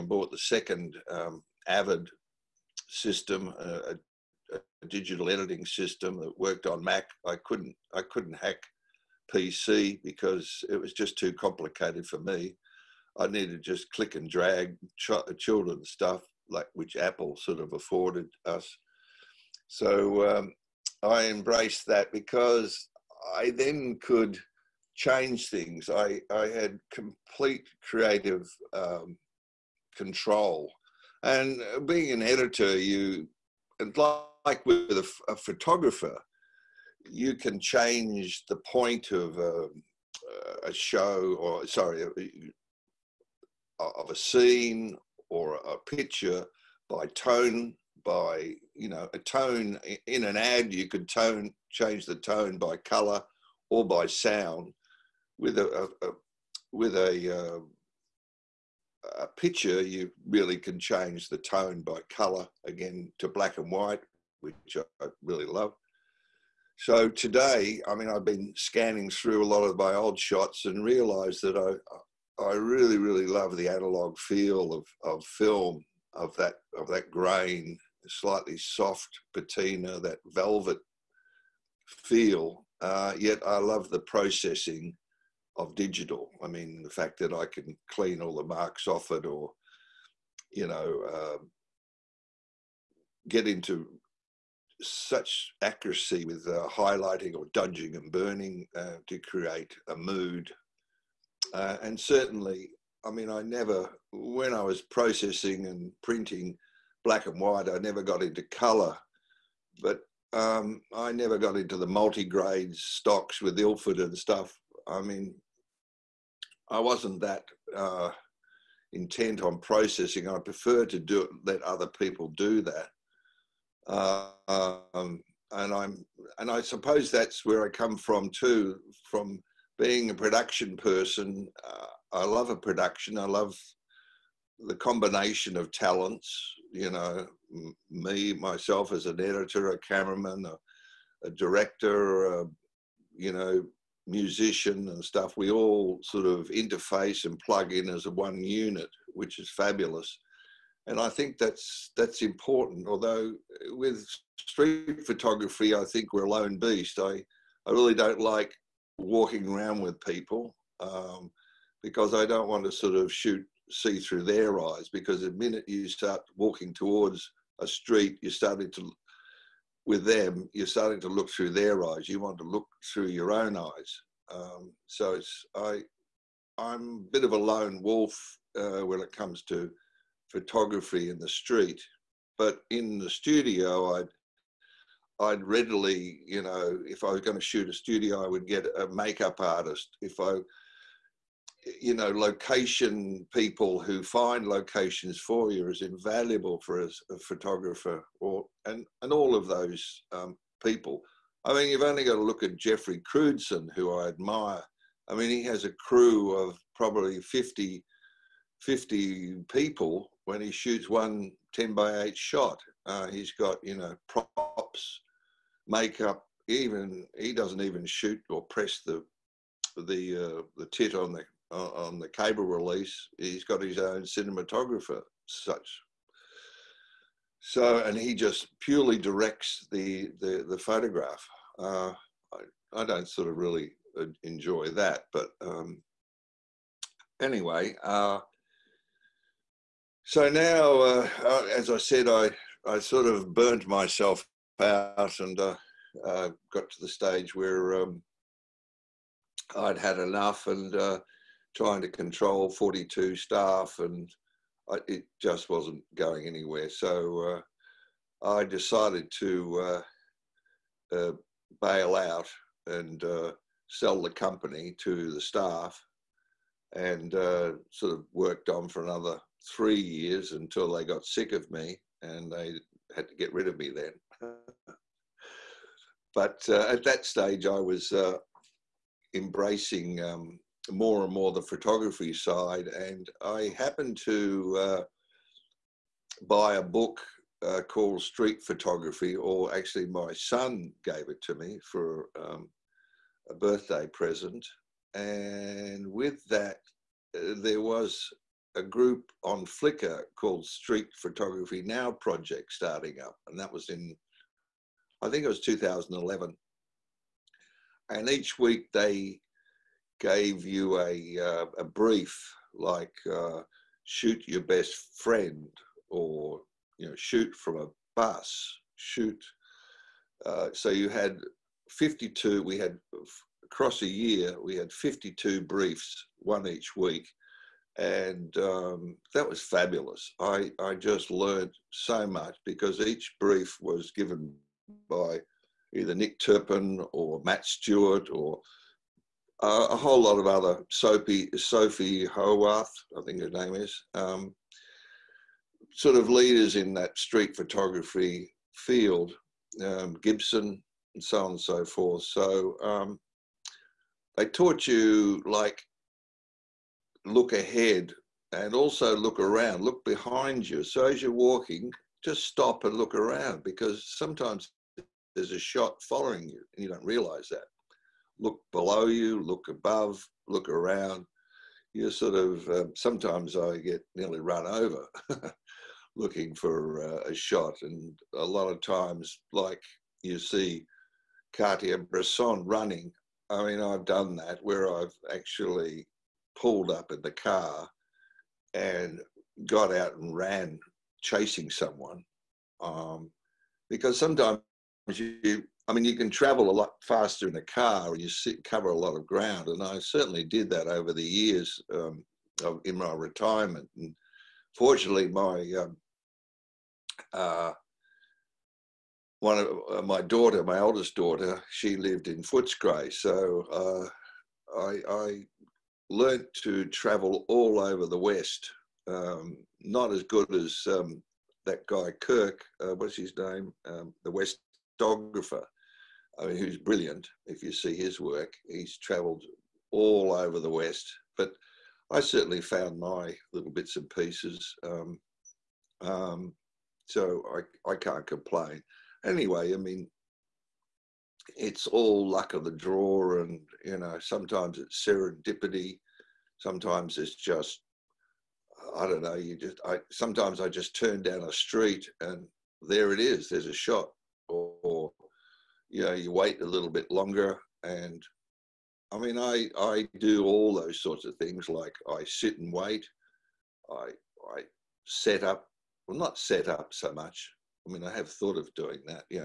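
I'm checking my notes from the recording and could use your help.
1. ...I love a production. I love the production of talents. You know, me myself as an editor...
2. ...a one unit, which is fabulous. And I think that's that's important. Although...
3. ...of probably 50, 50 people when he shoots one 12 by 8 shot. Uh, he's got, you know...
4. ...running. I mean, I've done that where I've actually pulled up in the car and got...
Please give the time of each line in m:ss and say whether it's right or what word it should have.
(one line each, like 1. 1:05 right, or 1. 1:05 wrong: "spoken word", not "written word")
1. 2:12 wrong: "combination", not "production"
2. 2:28 right
3. 3:26 wrong: "10", not "12"
4. 6:22 right.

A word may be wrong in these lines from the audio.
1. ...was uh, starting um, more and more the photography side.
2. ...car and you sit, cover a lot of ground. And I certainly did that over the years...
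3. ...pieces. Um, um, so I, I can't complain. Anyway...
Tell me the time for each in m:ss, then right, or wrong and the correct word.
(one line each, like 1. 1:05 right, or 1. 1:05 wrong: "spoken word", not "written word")
1. 4:37 wrong: "embracing", not "starting"
2. 6:37 right
3. 7:13 right.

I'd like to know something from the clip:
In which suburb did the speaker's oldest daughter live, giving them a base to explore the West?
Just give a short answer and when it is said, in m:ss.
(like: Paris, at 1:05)
Footscray, at 6:52.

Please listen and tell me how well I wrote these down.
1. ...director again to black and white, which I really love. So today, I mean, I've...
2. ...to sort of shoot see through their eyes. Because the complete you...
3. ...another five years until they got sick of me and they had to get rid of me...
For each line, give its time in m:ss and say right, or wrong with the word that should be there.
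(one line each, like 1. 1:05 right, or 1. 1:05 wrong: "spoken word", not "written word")
1. 1:02 wrong: "color", not "director"
2. 2:42 wrong: "minute", not "complete"
3. 4:28 wrong: "three", not "five".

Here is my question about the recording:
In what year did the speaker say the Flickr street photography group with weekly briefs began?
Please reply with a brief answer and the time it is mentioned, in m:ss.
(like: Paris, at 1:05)
2011, at 5:05.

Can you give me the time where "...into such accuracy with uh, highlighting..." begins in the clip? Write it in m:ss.
1:33.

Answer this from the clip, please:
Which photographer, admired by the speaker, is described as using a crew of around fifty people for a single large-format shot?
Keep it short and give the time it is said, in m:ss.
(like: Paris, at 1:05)
Jeffrey Crewdson, at 3:22.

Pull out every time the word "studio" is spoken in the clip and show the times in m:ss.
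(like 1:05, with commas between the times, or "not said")
3:03, 3:07.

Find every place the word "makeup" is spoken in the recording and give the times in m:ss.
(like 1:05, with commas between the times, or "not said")
3:08, 3:35.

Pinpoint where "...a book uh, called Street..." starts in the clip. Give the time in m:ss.
4:46.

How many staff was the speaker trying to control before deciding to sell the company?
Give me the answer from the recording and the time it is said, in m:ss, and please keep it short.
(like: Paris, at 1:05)
42, at 4:12.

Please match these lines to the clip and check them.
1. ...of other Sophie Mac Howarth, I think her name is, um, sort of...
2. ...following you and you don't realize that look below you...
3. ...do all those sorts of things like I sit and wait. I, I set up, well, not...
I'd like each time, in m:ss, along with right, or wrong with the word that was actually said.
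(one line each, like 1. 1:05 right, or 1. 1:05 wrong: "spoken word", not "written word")
1. 5:40 wrong: "Sophie", not "Mac"
2. 6:05 right
3. 7:39 right.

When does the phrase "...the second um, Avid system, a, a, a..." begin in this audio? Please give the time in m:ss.
0:00.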